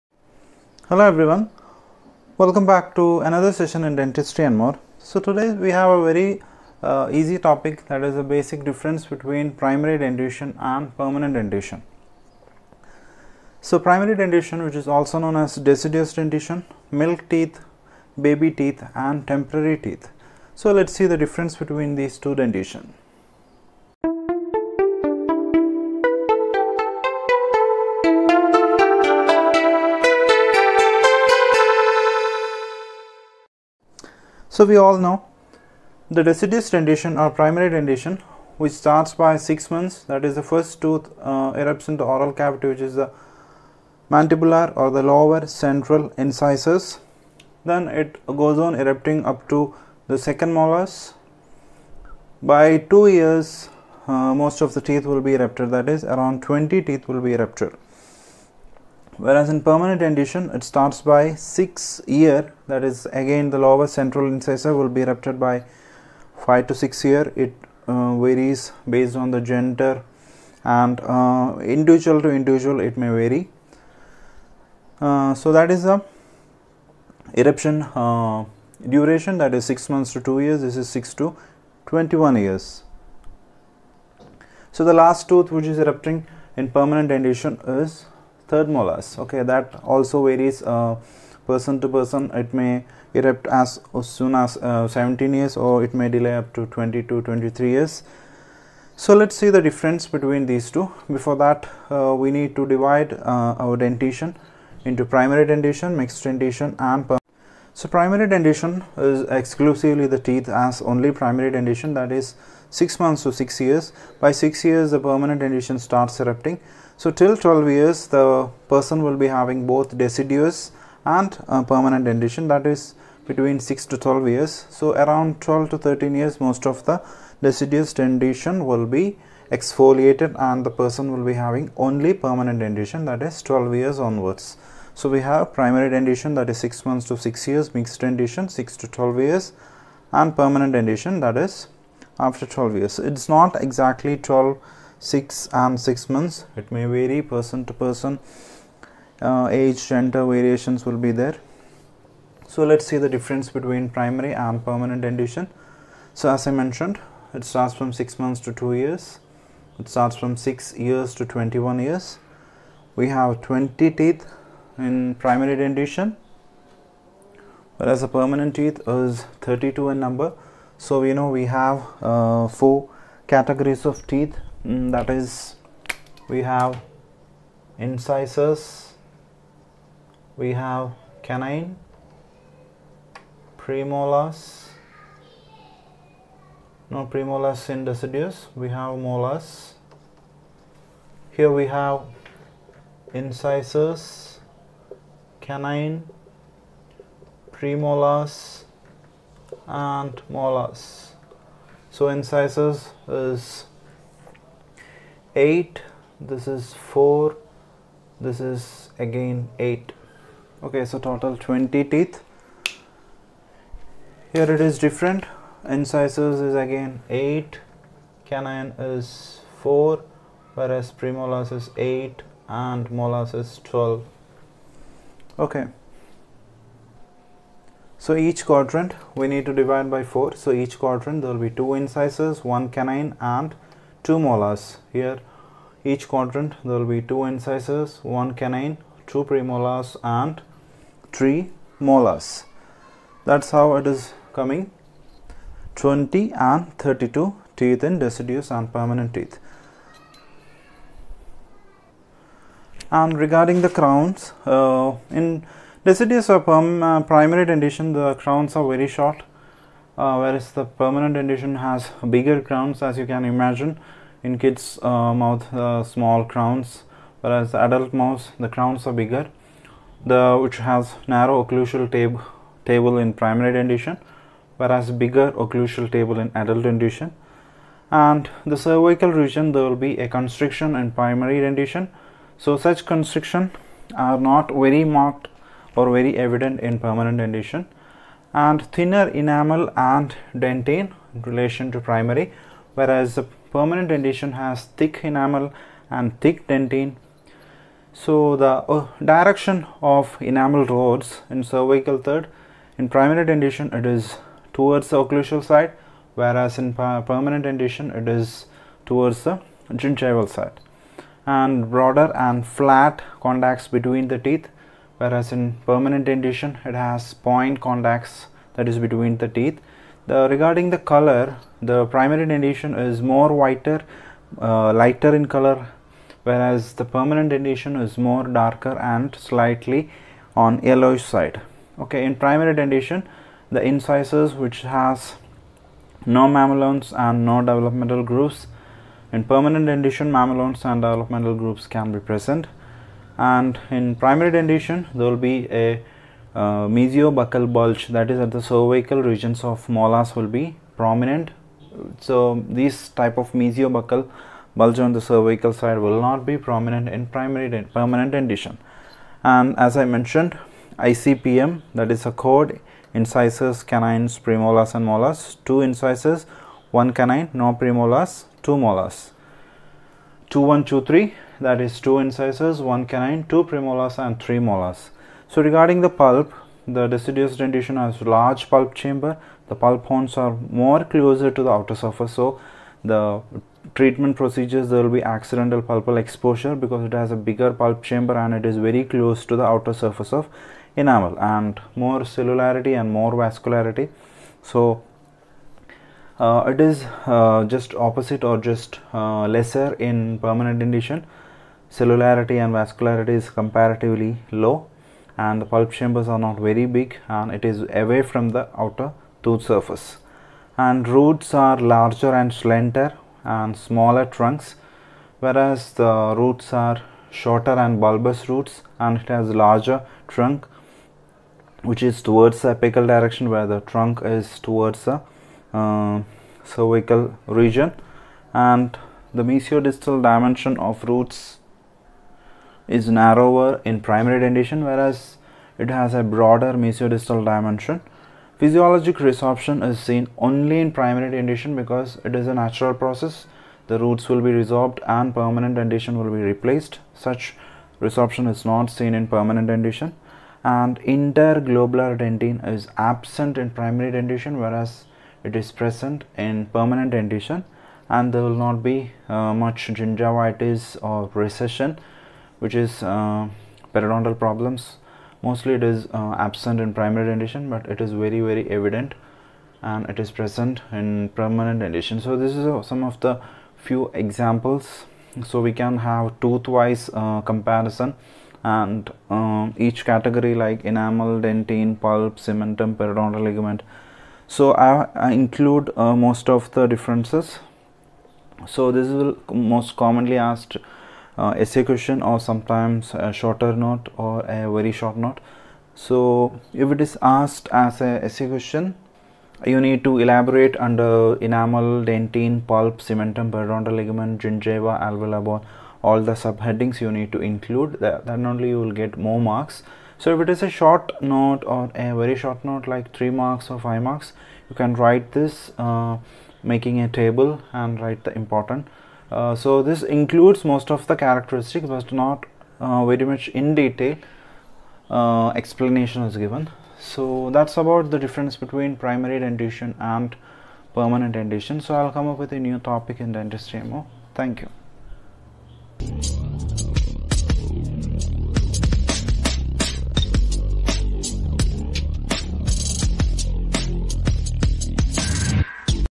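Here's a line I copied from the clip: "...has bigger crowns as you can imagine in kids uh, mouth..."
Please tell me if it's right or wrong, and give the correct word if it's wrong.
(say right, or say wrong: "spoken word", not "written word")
right.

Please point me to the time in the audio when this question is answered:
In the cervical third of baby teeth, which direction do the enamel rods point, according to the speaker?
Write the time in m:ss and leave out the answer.
5:04.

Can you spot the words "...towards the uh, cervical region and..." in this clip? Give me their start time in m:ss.
7:04.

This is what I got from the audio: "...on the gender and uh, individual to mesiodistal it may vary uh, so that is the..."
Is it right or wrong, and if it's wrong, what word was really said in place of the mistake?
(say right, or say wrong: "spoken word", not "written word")
wrong: "individual", not "mesiodistal".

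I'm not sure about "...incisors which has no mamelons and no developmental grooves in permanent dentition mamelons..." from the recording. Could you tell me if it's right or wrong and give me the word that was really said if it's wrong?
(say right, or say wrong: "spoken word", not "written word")
right.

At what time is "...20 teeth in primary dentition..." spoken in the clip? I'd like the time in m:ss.
2:43.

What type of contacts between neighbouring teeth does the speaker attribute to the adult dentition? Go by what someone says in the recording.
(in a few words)
Point contacts.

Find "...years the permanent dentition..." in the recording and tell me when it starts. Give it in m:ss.
1:54.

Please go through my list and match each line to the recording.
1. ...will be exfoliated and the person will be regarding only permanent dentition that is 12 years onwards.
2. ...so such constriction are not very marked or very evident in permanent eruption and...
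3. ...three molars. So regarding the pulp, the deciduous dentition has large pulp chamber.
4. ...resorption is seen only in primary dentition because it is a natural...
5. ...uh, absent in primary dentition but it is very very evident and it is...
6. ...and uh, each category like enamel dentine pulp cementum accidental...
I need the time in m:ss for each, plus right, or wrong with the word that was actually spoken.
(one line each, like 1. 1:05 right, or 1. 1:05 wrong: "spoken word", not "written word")
1. 2:08 wrong: "having", not "regarding"
2. 4:42 wrong: "dentition", not "eruption"
3. 6:14 right
4. 7:18 right
5. 7:45 right
6. 7:58 wrong: "periodontal", not "accidental".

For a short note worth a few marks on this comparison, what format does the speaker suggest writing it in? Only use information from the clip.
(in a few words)
A table.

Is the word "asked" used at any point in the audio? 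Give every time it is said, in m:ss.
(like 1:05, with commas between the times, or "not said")
8:10, 8:17.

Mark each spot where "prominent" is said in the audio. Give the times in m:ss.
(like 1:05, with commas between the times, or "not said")
5:50, 5:56.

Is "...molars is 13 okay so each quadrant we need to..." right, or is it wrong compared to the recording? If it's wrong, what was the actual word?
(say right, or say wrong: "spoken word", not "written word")
wrong: "12", not "13".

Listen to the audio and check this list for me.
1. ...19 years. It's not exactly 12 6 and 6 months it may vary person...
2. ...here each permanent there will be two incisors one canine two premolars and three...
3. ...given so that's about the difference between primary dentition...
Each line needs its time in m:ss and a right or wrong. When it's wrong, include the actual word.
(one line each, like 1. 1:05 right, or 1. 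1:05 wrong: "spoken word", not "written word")
1. 2:22 wrong: "12", not "19"
2. 3:54 wrong: "quadrant", not "permanent"
3. 8:46 right.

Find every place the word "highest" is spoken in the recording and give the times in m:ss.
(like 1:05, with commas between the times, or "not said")
not said.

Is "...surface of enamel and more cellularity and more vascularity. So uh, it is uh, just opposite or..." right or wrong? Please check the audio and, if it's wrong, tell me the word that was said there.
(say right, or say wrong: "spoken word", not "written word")
right.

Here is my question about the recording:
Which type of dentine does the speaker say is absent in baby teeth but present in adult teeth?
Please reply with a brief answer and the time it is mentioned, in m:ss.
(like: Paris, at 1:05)
Interglobular dentine, at 7:30.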